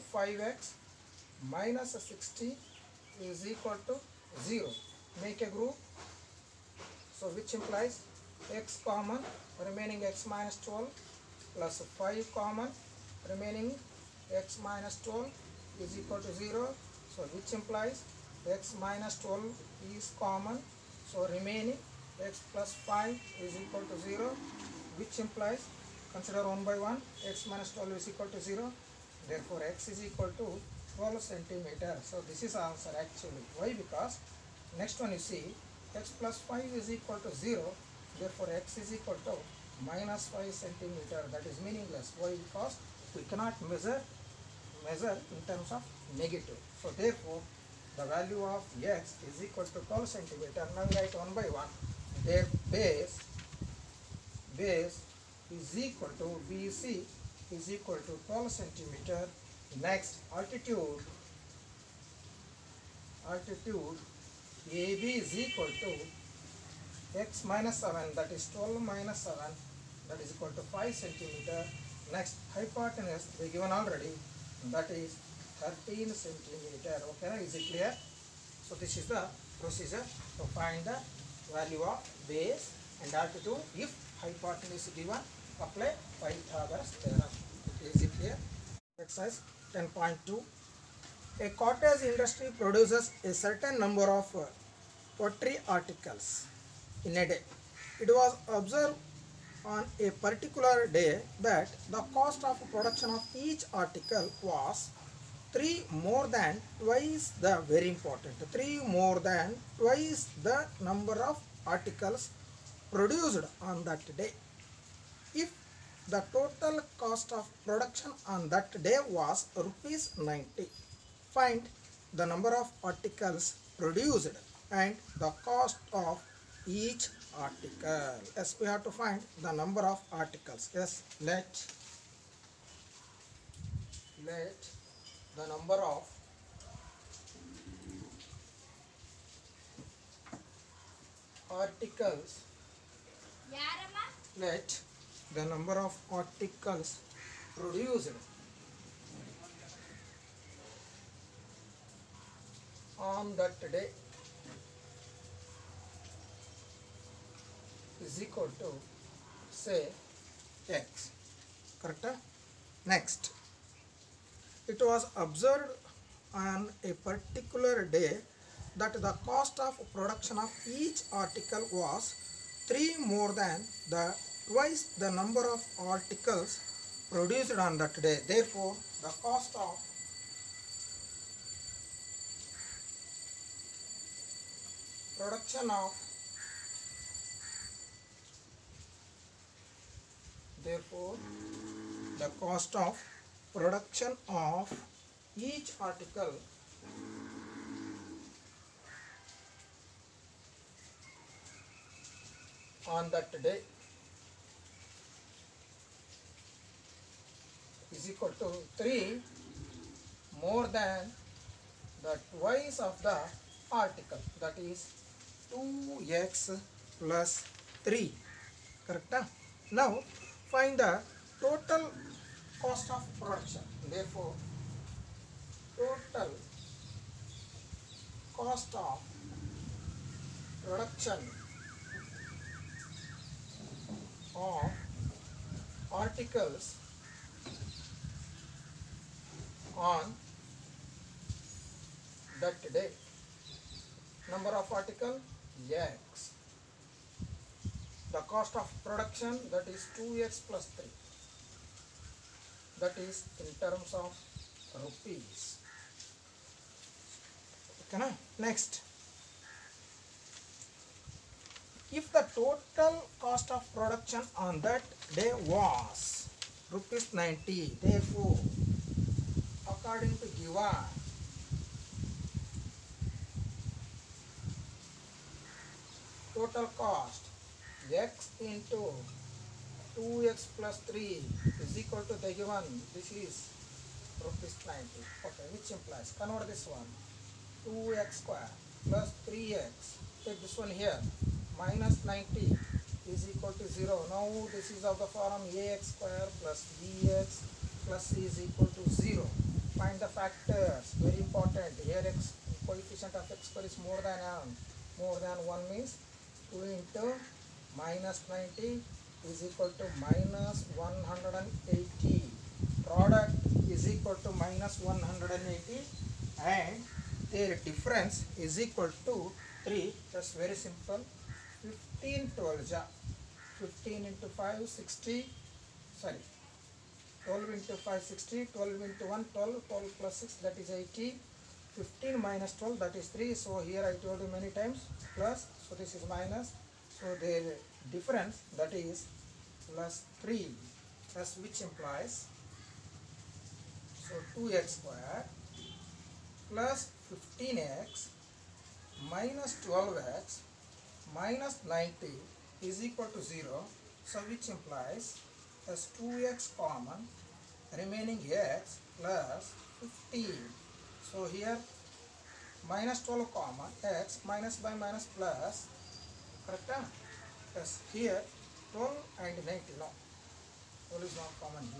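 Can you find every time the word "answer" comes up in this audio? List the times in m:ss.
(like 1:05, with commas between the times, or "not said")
0:32.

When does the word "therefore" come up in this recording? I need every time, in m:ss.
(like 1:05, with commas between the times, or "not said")
0:29, 0:38, 0:46, 2:58, 3:10, 3:43, 4:27.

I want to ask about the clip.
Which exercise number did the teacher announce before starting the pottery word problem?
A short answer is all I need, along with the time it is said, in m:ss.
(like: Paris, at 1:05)
10.2, at 1:29.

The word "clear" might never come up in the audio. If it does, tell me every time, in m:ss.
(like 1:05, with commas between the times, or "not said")
1:17, 1:28.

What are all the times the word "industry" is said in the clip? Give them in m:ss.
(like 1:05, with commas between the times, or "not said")
1:32.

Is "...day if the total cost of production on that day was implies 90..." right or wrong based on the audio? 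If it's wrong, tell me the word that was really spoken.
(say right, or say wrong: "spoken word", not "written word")
wrong: "rupees", not "implies".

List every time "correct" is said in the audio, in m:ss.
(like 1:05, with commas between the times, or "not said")
2:41, 3:38, 6:06.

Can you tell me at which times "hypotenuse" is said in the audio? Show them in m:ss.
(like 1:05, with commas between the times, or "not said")
1:12, 1:24.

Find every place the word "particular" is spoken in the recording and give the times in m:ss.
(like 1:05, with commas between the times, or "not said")
1:40, 2:47.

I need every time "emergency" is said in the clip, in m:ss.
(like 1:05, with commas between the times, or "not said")
not said.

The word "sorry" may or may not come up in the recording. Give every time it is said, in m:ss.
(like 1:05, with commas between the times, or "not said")
5:25.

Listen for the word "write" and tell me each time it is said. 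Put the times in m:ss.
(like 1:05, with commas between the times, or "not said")
0:50.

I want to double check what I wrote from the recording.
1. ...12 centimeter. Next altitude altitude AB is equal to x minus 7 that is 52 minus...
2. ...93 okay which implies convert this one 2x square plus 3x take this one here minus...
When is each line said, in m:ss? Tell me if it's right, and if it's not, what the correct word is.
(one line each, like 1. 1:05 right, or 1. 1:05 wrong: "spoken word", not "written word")
1. 0:58 wrong: "12", not "52"
2. 4:44 wrong: "90", not "93".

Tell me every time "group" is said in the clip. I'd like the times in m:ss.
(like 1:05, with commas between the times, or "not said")
0:05.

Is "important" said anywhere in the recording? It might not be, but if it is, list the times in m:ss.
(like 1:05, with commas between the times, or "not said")
1:47, 5:01.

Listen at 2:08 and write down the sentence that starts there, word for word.
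Yes, we have to find the number of articles.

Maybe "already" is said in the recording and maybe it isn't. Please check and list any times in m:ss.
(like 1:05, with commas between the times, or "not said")
1:13.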